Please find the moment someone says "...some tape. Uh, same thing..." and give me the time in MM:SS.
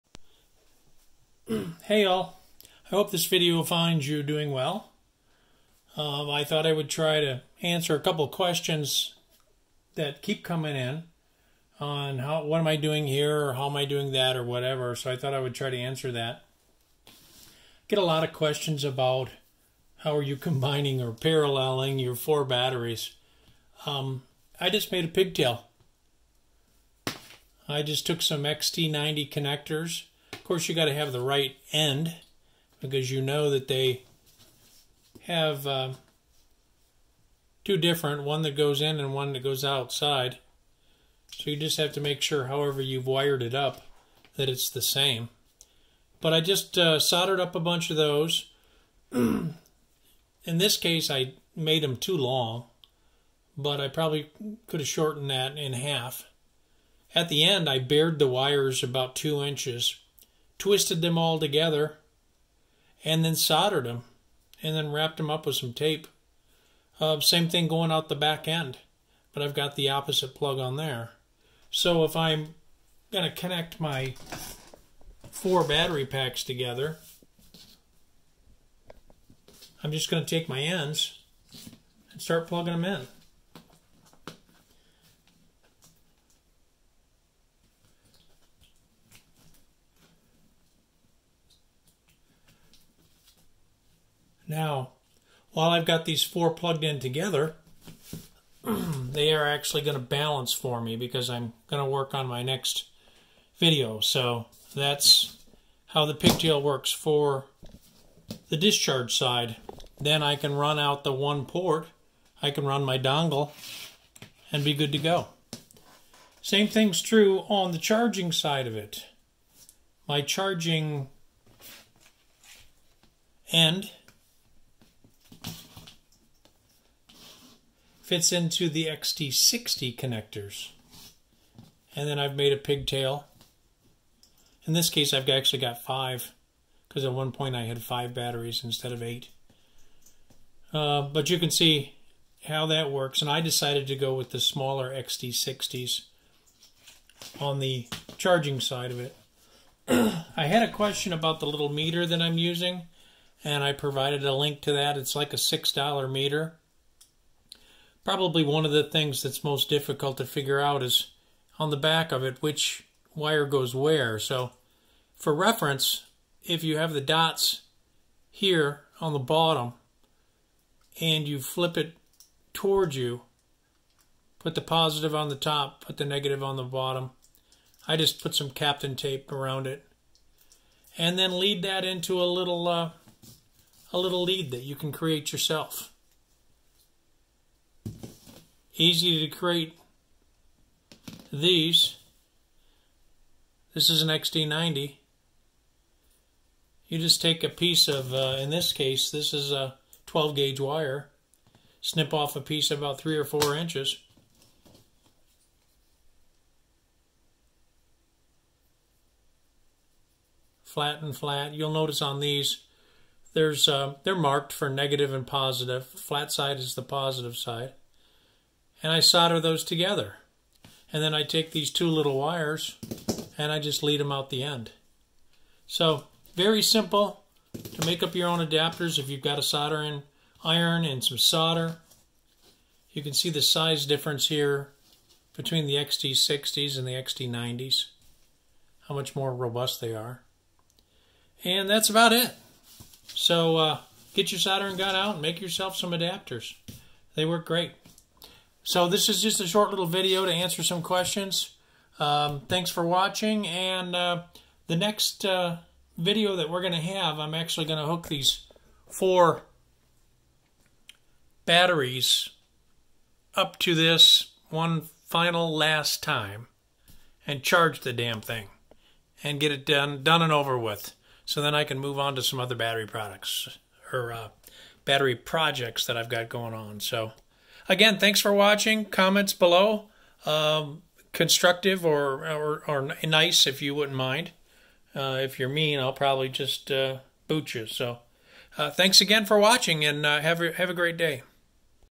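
01:05.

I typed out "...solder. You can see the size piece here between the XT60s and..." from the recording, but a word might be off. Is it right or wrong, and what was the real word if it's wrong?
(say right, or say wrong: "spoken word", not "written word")
wrong: "difference", not "piece".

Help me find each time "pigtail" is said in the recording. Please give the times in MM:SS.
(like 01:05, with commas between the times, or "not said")
00:25, 01:46, 02:12.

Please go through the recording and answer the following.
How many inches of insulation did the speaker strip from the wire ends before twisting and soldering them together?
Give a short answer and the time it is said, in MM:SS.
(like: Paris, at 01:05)
2 inches, at 00:59.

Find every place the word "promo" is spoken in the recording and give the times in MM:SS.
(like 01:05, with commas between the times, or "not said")
not said.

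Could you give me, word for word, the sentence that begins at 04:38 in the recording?
Comments below, um, constructive or, or, or nice if you wouldn't mind.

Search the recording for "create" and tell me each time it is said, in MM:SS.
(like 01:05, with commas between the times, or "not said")
03:04, 03:09.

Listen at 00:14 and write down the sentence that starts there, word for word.
So I thought I would try to answer that.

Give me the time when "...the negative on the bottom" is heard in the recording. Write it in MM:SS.
02:55.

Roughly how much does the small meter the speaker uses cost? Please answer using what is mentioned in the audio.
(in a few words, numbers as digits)
$6.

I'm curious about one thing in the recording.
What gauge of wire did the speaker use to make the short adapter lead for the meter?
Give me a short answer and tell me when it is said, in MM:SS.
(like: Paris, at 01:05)
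12 gauge, at 03:20.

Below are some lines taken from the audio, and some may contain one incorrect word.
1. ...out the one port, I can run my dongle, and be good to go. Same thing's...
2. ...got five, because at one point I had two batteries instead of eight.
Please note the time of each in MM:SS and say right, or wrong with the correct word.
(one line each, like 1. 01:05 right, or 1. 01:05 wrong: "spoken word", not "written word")
1. 01:50 right
2. 02:15 wrong: "five", not "two".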